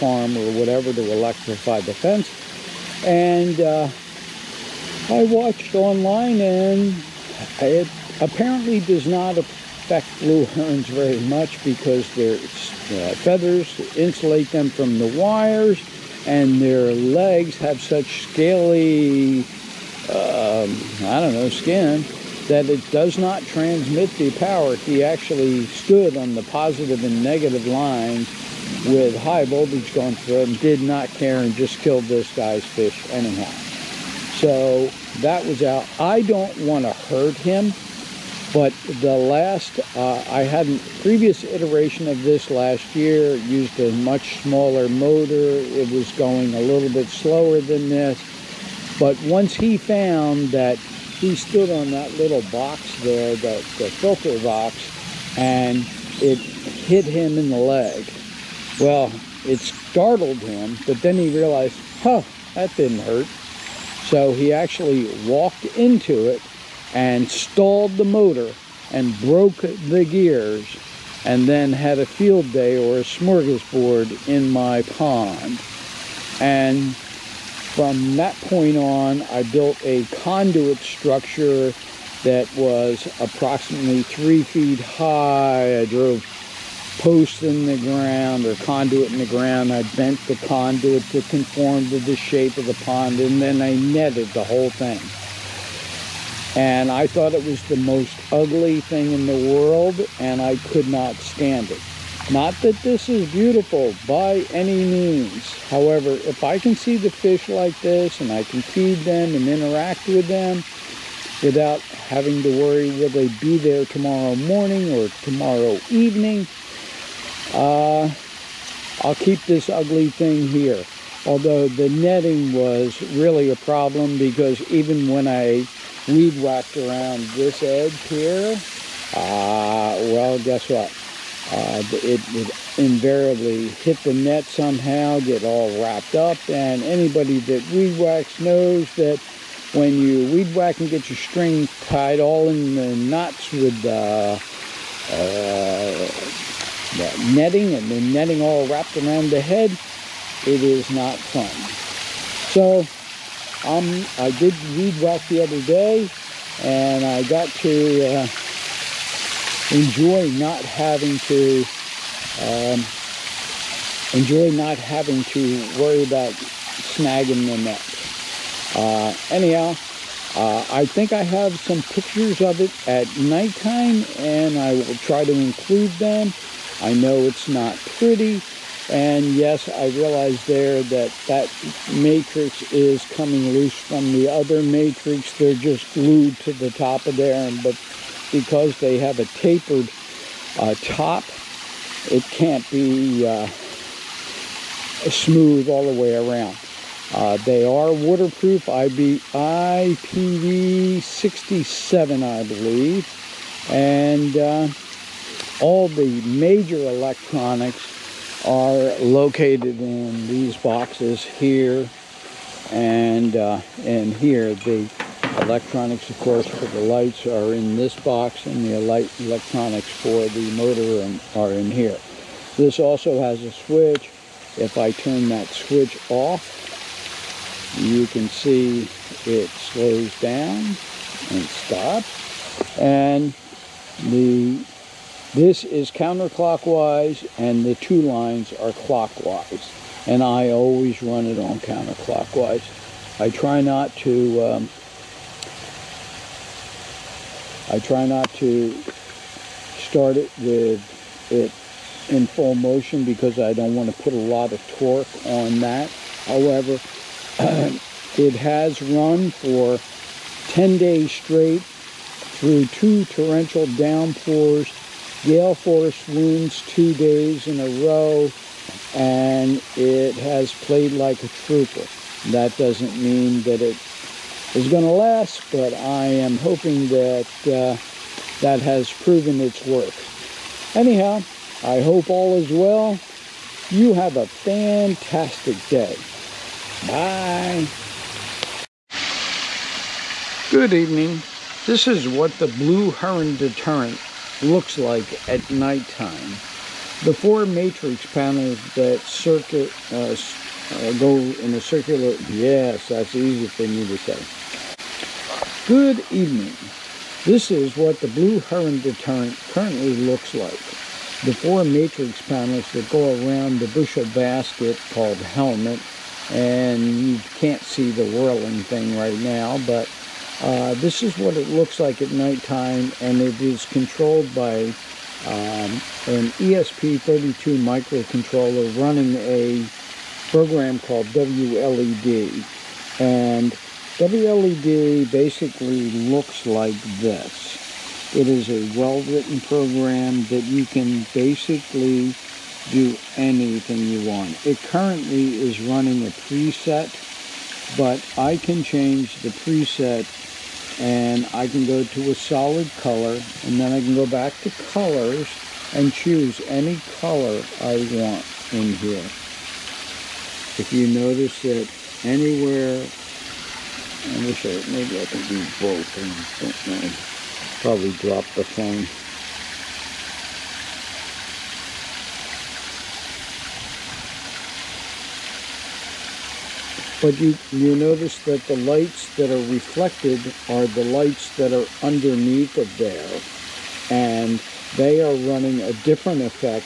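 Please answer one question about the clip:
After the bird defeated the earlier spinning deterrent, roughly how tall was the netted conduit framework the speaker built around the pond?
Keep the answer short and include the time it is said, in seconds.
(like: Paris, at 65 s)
3 feet, at 84 s.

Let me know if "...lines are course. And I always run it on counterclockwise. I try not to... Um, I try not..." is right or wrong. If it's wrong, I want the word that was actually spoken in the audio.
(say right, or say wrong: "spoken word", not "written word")
wrong: "clockwise", not "course".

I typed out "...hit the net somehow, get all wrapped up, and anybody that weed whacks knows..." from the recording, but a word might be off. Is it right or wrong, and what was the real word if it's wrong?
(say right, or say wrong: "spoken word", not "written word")
right.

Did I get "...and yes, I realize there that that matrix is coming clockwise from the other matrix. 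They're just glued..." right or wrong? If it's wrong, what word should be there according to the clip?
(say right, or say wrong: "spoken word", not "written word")
wrong: "loose", not "clockwise".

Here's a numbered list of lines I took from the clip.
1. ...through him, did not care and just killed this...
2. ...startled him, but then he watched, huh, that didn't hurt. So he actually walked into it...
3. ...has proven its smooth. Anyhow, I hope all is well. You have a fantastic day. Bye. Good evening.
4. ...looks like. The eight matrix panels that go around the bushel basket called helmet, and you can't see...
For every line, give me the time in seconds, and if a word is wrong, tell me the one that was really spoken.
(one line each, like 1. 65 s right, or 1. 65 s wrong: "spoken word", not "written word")
1. 30 s right
2. 59 s wrong: "realized", not "watched"
3. 278 s wrong: "worth", not "smooth"
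4. 309 s wrong: "four", not "eight".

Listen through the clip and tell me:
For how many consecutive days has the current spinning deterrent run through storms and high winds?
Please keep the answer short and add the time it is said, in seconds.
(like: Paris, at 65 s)
10, at 260 s.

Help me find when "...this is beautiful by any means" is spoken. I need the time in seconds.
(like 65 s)
102 s.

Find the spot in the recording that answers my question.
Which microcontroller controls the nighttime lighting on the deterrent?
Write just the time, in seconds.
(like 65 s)
326 s.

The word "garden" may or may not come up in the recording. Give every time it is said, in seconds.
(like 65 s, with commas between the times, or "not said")
not said.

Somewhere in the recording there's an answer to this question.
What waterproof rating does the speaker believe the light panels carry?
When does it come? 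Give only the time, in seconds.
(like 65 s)
199 s.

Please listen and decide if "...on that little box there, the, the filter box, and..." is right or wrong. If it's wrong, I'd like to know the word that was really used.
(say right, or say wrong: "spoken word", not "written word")
right.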